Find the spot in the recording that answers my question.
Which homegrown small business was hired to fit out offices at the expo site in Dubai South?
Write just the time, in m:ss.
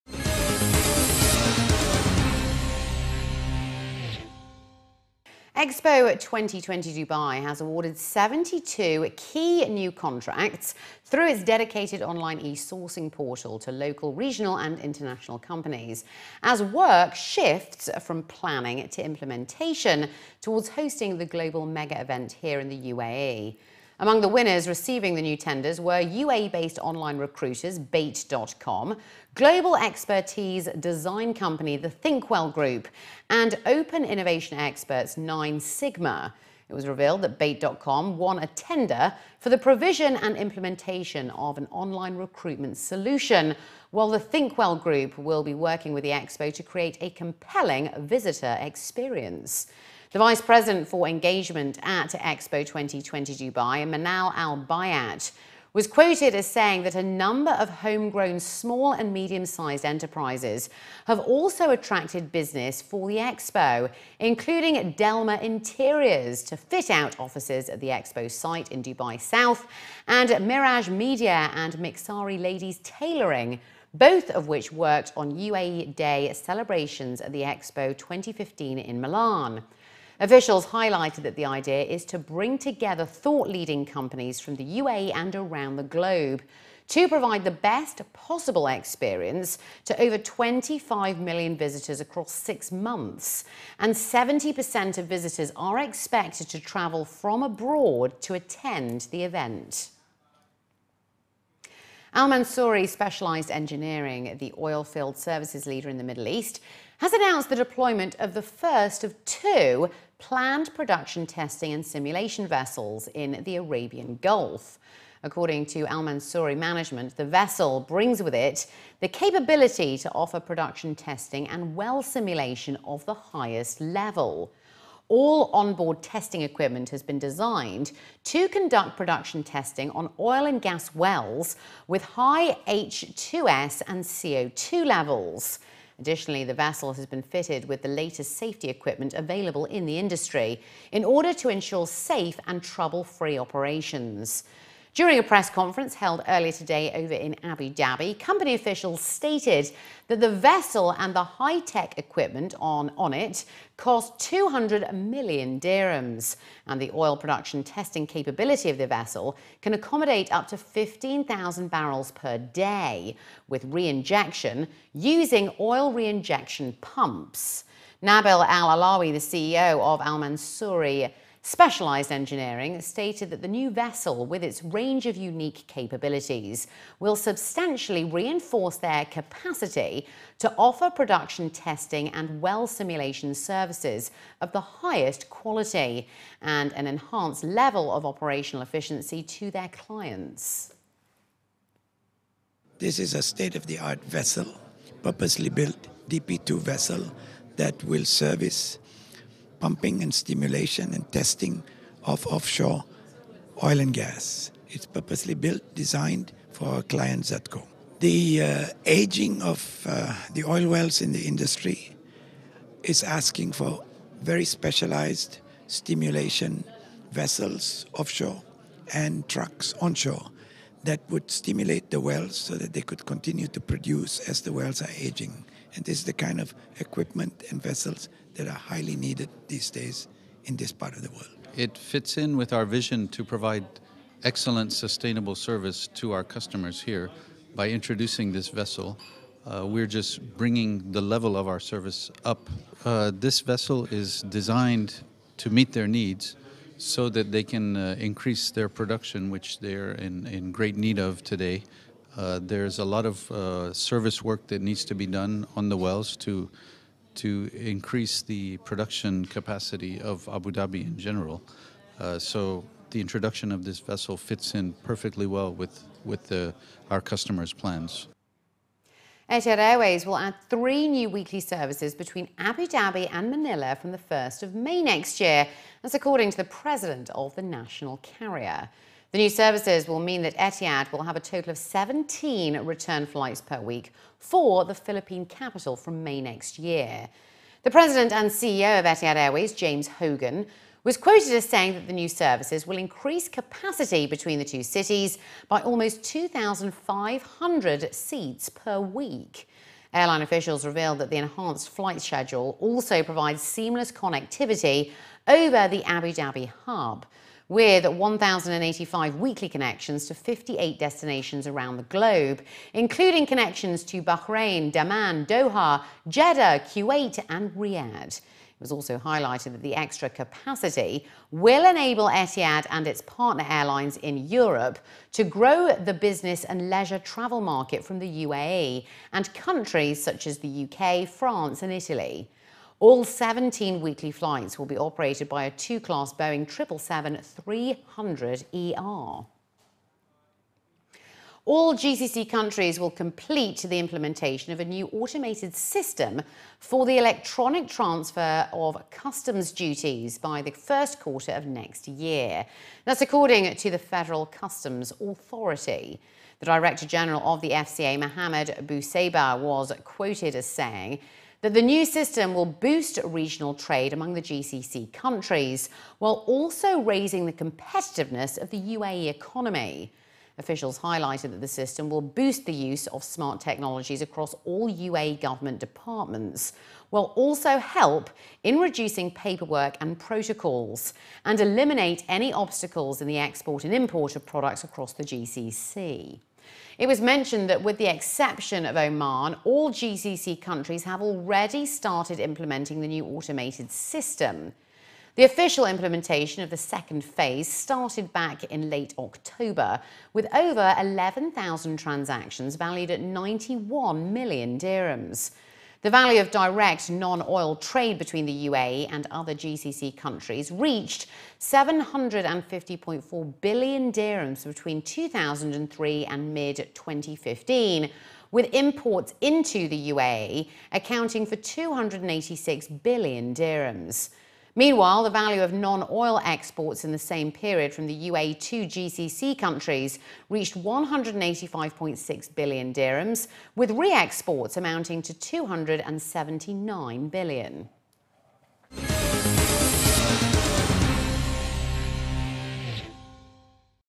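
1:04.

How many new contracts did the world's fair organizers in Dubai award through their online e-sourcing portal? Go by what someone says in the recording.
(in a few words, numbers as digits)
72.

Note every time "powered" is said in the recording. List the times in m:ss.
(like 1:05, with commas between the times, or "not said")
not said.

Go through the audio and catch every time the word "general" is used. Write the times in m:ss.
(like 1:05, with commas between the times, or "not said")
4:20, 5:56.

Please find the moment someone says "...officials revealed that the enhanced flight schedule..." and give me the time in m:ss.
5:00.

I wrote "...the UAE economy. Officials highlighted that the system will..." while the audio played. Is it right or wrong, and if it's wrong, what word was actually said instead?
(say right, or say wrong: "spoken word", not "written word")
right.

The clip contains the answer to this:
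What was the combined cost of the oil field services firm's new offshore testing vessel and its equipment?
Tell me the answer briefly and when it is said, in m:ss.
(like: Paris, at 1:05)
200 million dirhams, at 2:34.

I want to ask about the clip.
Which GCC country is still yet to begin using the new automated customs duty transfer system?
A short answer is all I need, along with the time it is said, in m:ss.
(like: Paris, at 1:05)
Oman, at 6:28.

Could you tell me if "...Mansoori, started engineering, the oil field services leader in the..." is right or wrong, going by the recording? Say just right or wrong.
wrong.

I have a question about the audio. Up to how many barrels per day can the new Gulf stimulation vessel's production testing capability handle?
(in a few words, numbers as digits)
15,000.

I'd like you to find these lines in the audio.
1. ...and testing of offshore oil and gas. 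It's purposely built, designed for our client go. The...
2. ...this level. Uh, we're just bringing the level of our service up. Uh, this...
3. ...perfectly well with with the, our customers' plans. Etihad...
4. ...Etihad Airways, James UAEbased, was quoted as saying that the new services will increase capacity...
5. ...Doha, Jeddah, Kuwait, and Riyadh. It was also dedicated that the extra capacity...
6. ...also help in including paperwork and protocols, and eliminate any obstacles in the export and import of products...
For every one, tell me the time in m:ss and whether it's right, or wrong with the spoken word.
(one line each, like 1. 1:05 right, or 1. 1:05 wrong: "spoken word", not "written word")
1. 3:20 right
2. 3:58 wrong: "vessel", not "level"
3. 4:24 right
4. 4:48 wrong: "Hogan", not "UAEbased"
5. 5:15 wrong: "highlighted", not "dedicated"
6. 6:17 wrong: "reducing", not "including".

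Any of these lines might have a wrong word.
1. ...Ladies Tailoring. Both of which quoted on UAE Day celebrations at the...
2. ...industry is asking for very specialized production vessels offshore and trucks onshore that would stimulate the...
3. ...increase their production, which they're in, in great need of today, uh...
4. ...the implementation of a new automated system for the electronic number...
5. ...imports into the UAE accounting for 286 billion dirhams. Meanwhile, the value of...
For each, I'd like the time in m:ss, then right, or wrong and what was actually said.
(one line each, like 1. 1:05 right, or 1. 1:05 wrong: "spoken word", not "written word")
1. 1:12 wrong: "worked", not "quoted"
2. 3:31 wrong: "stimulation", not "production"
3. 4:07 right
4. 5:43 wrong: "transfer", not "number"
5. 6:58 right.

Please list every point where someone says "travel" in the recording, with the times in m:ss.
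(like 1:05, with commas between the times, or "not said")
1:36, 5:26.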